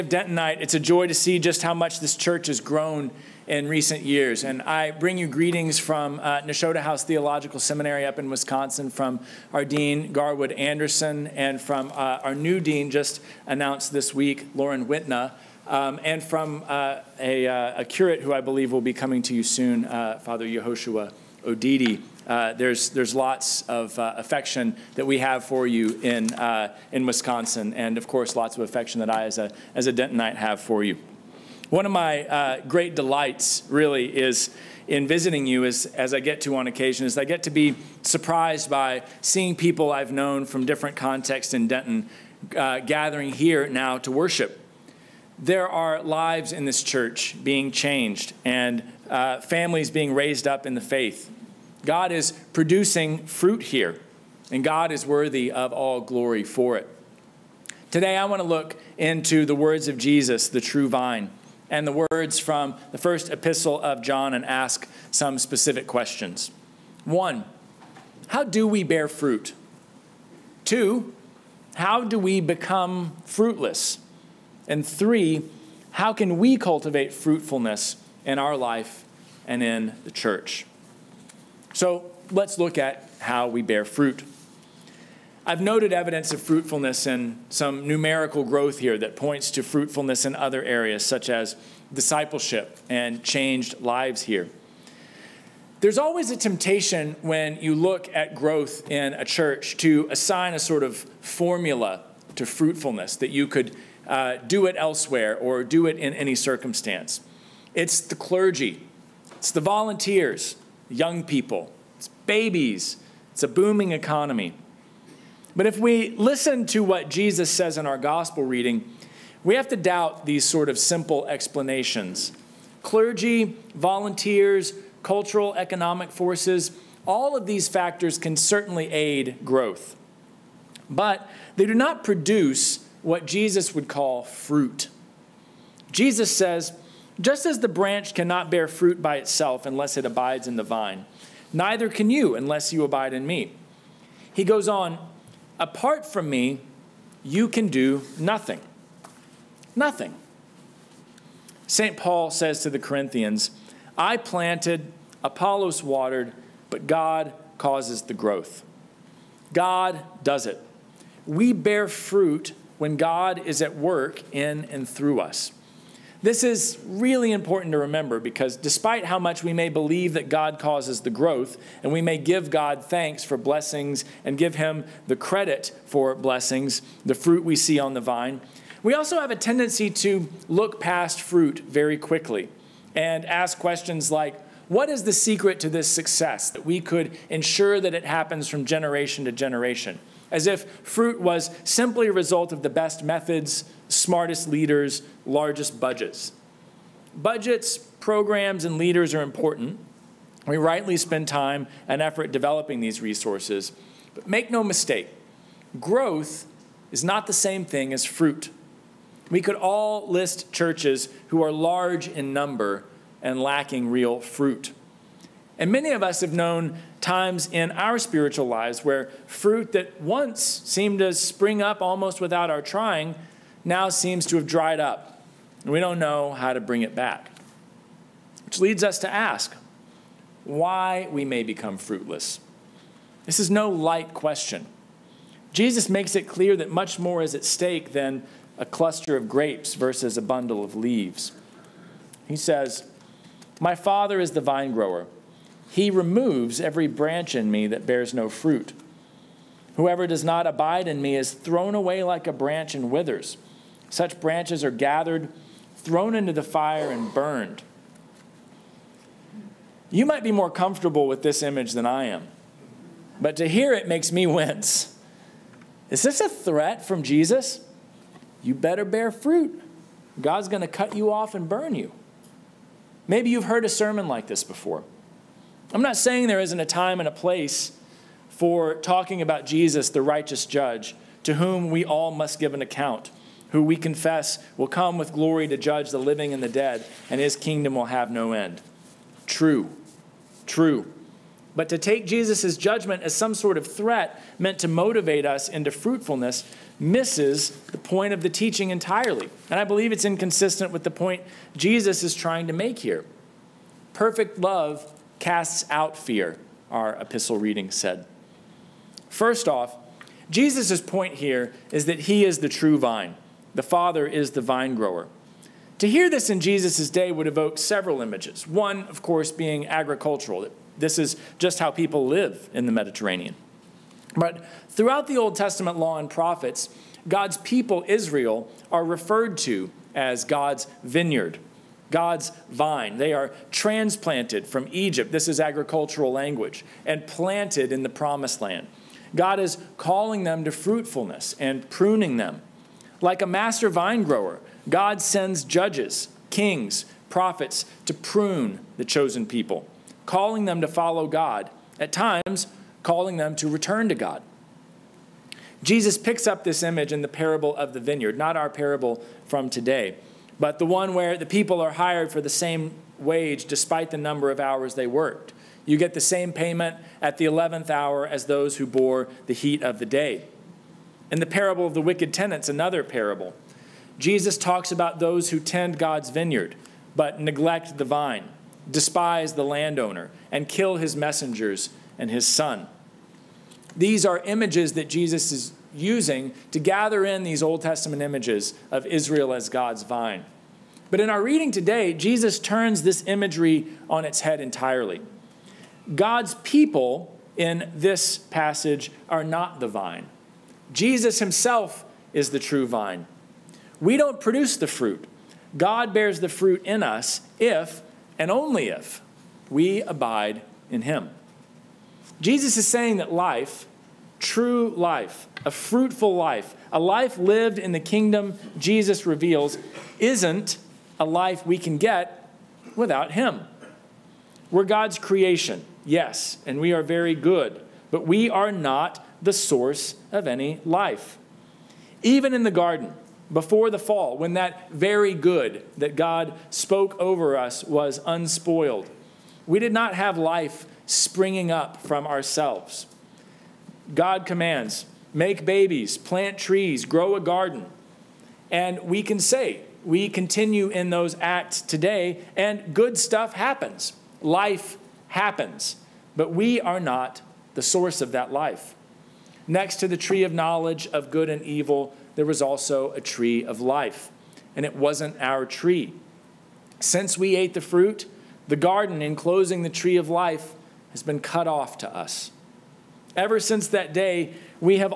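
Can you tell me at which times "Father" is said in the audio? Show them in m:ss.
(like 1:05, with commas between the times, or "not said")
0:20, 4:03, 5:13.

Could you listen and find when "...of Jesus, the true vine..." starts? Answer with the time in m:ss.
0:59.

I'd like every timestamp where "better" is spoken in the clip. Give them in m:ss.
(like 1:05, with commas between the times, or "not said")
4:28.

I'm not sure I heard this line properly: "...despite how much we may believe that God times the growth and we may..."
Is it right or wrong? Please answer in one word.
wrong.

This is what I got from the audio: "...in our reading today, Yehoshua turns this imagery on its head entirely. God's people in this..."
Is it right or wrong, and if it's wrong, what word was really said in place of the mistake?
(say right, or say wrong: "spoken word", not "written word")
wrong: "Jesus", not "Yehoshua".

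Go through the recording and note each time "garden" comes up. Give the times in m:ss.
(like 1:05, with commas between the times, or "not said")
7:12, 7:27, 7:48.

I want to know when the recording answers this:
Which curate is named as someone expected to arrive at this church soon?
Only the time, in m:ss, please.
0:20.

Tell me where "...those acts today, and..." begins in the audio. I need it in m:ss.
7:30.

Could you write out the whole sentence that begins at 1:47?
It's the clergy, it's the volunteers, young people, it's babies, it's a booming economy.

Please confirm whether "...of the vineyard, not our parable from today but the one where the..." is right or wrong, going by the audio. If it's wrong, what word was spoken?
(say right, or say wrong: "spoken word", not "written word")
right.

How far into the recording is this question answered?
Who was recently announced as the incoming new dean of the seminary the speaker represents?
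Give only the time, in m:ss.
0:14.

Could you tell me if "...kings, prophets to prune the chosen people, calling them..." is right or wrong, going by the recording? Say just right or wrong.
right.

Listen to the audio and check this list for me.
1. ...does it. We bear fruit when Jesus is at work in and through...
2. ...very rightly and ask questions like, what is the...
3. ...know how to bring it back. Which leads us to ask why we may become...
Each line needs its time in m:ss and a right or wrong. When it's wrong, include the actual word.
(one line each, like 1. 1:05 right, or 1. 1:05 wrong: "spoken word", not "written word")
1. 2:40 wrong: "God", not "Jesus"
2. 3:01 wrong: "quickly", not "rightly"
3. 3:45 right.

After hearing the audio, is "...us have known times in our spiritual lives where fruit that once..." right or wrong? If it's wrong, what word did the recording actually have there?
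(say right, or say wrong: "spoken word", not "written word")
right.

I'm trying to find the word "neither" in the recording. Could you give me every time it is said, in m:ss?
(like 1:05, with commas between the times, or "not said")
2:21.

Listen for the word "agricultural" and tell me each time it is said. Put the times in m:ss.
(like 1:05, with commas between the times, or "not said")
5:19, 5:35.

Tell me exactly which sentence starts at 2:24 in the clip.
He goes on, apart from me, you can do nothing.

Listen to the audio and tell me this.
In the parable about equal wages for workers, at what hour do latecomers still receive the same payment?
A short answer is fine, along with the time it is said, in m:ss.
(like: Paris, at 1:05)
11th hour, at 6:07.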